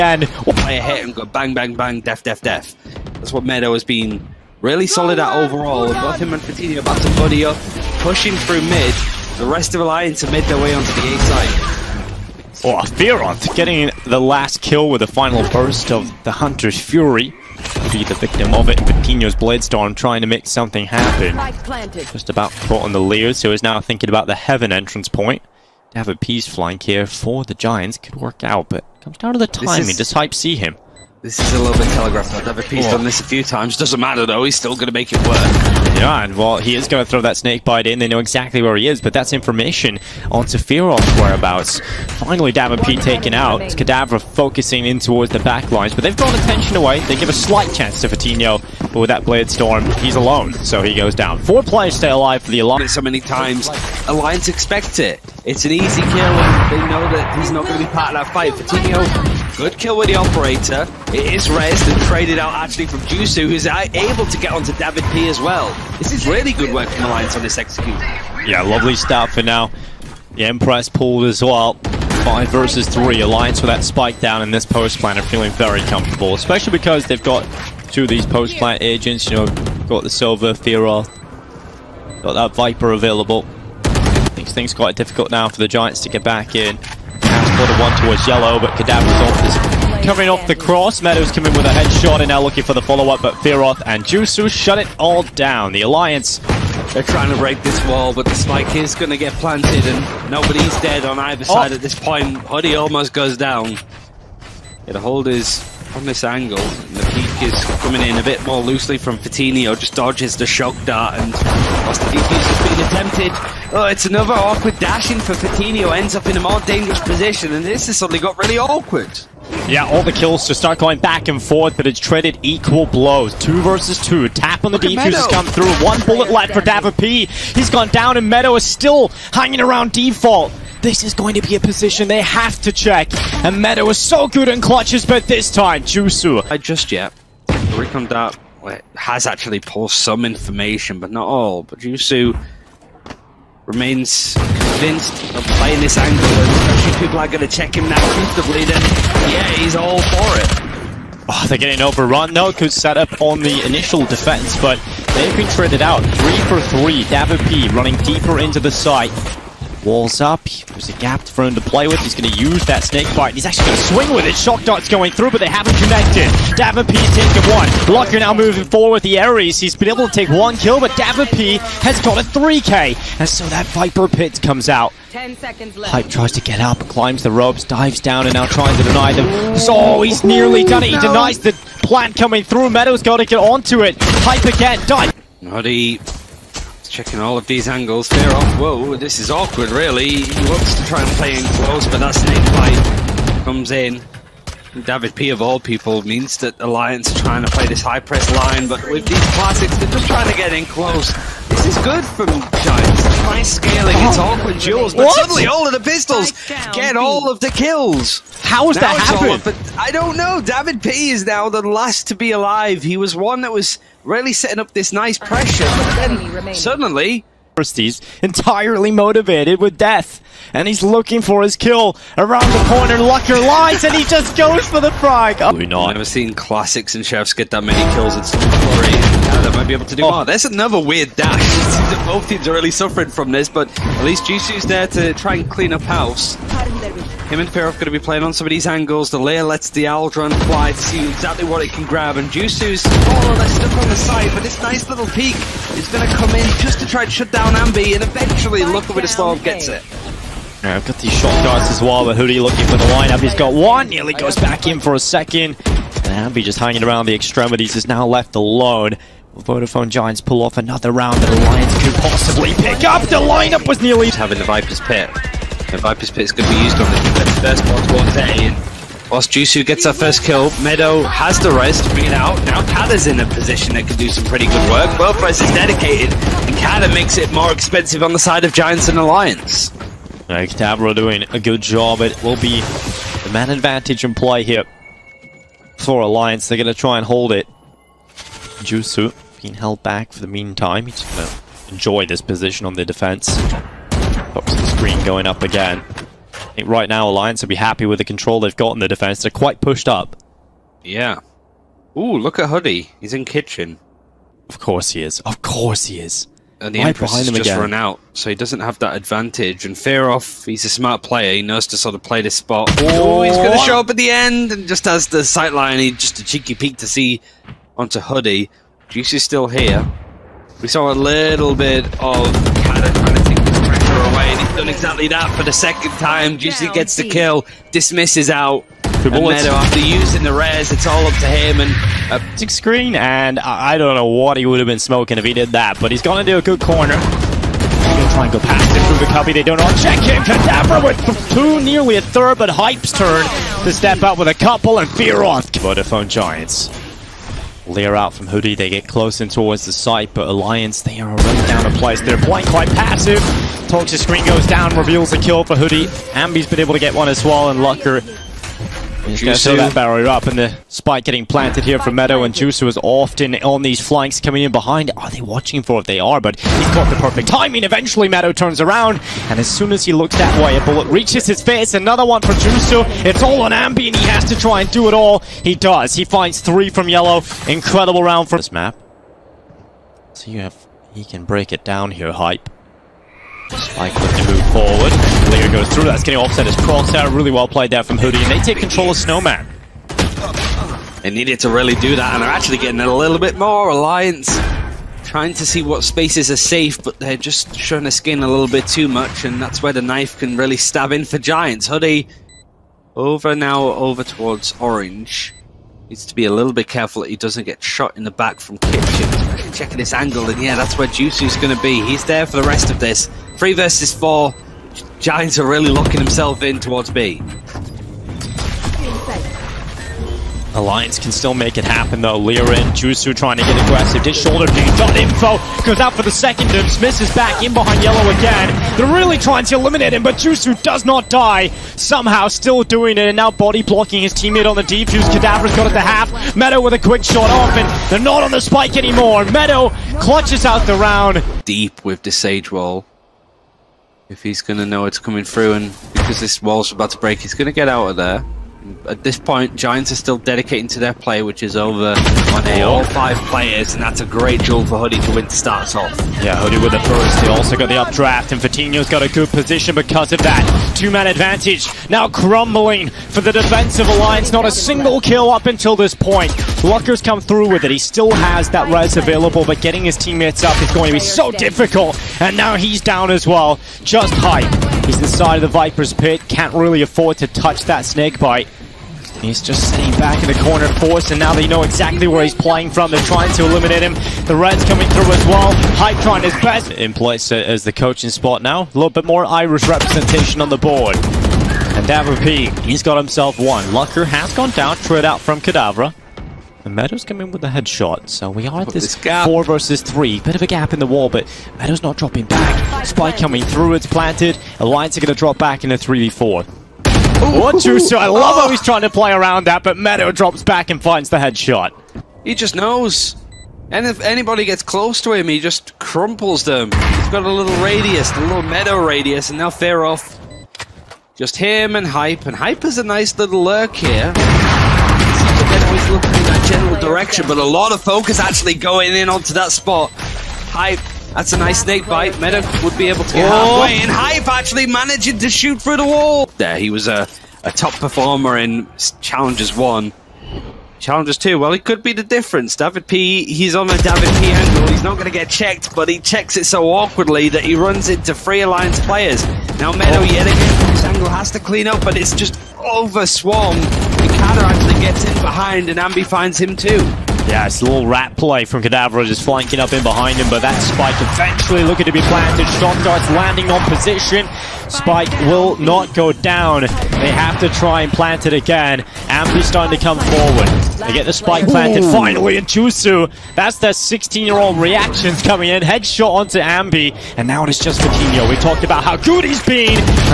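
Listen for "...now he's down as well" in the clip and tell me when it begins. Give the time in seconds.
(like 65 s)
472 s.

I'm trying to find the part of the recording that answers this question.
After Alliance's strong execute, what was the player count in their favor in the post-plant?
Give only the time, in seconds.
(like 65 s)
72 s.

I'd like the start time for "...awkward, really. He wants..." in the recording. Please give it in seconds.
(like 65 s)
189 s.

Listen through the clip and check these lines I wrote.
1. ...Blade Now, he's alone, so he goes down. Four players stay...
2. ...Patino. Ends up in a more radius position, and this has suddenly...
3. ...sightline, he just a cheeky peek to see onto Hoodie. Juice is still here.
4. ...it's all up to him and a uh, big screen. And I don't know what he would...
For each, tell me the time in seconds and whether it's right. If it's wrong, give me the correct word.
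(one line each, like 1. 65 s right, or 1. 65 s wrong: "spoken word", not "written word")
1. 49 s wrong: "Storm", not "Now"
2. 115 s wrong: "dangerous", not "radius"
3. 315 s right
4. 330 s right.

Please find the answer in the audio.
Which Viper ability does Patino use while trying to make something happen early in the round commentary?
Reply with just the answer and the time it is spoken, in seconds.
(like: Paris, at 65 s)
Bladestorm, at 18 s.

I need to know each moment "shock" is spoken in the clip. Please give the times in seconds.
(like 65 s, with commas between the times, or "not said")
110 s, 164 s.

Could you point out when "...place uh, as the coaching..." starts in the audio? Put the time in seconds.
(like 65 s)
486 s.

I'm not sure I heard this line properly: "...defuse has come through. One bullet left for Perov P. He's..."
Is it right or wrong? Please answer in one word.
wrong.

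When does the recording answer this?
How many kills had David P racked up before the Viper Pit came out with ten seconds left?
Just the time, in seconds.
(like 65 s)
172 s.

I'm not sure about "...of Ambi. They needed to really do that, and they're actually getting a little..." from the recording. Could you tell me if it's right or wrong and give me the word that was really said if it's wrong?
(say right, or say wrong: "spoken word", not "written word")
wrong: "Snowman", not "Ambi".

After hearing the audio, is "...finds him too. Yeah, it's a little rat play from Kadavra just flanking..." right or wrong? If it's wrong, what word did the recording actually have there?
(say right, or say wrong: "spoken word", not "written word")
right.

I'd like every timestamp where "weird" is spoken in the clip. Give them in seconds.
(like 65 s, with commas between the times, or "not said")
230 s.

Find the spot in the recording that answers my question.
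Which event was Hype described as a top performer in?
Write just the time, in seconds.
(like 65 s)
539 s.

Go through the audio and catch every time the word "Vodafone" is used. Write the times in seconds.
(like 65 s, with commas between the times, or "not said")
259 s, 345 s.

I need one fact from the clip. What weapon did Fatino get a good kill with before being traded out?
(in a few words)
Operator.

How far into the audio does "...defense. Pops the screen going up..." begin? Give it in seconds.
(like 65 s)
292 s.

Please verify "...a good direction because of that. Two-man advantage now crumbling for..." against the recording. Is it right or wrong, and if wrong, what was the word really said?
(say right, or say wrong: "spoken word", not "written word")
wrong: "position", not "direction".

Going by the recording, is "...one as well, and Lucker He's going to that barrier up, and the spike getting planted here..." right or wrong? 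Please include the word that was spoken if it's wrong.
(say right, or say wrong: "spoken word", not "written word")
right.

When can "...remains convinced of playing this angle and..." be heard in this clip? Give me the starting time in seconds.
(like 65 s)
143 s.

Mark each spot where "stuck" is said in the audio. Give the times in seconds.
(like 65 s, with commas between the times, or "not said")
243 s.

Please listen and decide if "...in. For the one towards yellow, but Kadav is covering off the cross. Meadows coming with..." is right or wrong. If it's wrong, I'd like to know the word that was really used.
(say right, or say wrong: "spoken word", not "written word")
right.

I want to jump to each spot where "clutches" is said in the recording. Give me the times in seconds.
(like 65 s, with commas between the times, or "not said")
134 s, 440 s.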